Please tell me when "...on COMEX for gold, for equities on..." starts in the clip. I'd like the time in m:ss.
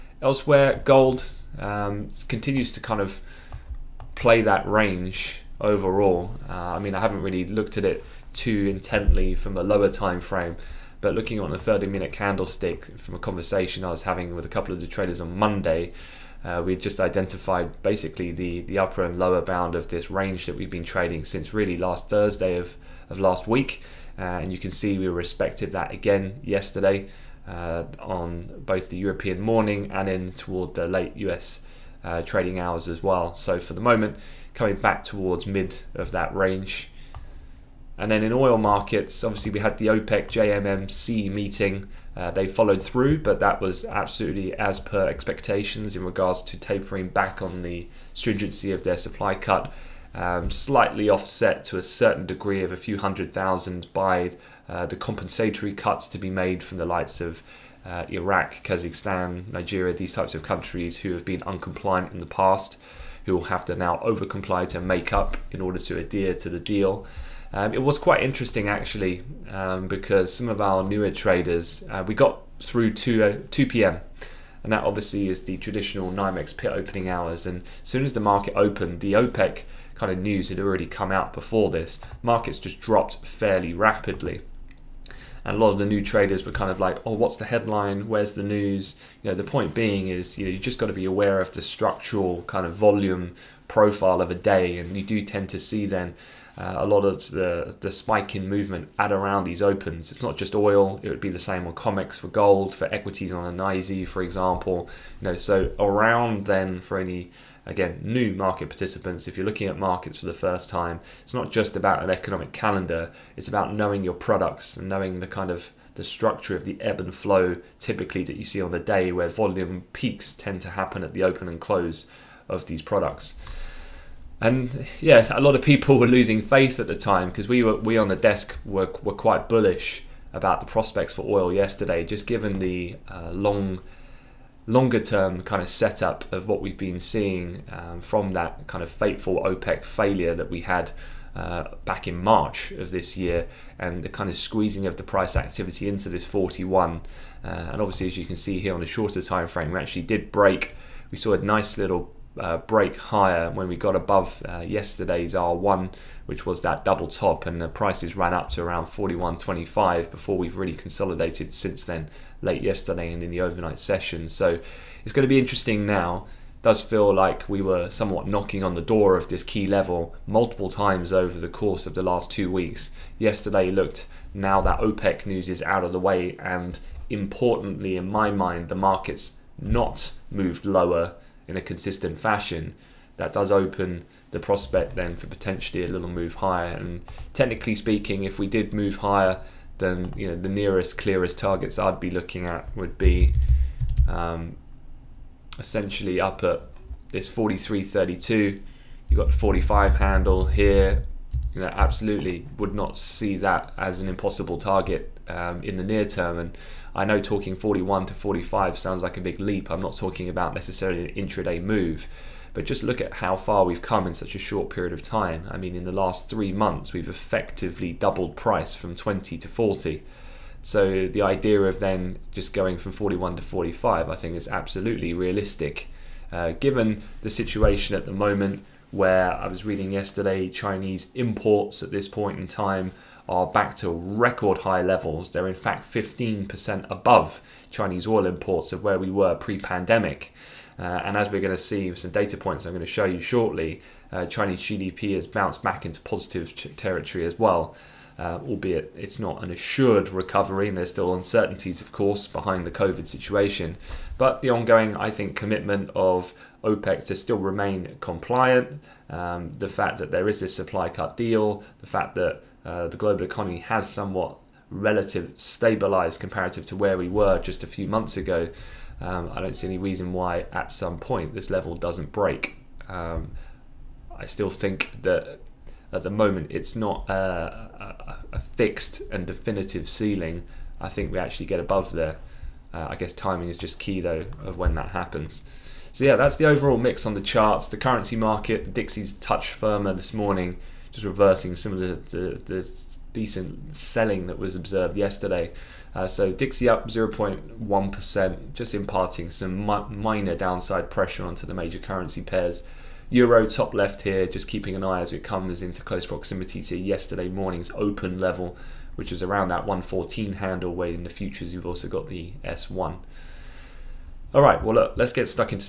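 1:41.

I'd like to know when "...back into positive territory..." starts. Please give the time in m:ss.
4:05.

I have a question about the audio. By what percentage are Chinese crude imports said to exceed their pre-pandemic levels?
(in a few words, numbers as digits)
15%.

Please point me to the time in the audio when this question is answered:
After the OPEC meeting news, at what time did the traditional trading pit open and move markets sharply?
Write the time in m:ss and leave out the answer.
1:13.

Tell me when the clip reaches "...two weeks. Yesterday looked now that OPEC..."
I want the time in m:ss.
2:52.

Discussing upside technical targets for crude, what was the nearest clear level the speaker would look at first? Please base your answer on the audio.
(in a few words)
43.32.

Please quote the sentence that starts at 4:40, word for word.
I think we actually get above there.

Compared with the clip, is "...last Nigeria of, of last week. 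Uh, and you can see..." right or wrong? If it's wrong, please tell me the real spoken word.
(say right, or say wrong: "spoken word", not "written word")
wrong: "Thursday", not "Nigeria".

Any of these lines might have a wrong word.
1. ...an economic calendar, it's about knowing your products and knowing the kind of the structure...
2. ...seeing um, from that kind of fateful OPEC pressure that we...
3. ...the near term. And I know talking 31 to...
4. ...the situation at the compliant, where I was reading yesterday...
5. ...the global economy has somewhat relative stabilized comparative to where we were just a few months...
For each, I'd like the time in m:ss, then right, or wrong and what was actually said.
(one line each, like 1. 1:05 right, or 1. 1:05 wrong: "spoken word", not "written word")
1. 1:52 right
2. 2:17 wrong: "failure", not "pressure"
3. 3:25 wrong: "41", not "31"
4. 3:47 wrong: "moment", not "compliant"
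5. 4:22 right.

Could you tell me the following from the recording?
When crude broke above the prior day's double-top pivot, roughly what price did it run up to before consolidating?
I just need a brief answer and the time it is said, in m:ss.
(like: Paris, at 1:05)
41.25, at 2:38.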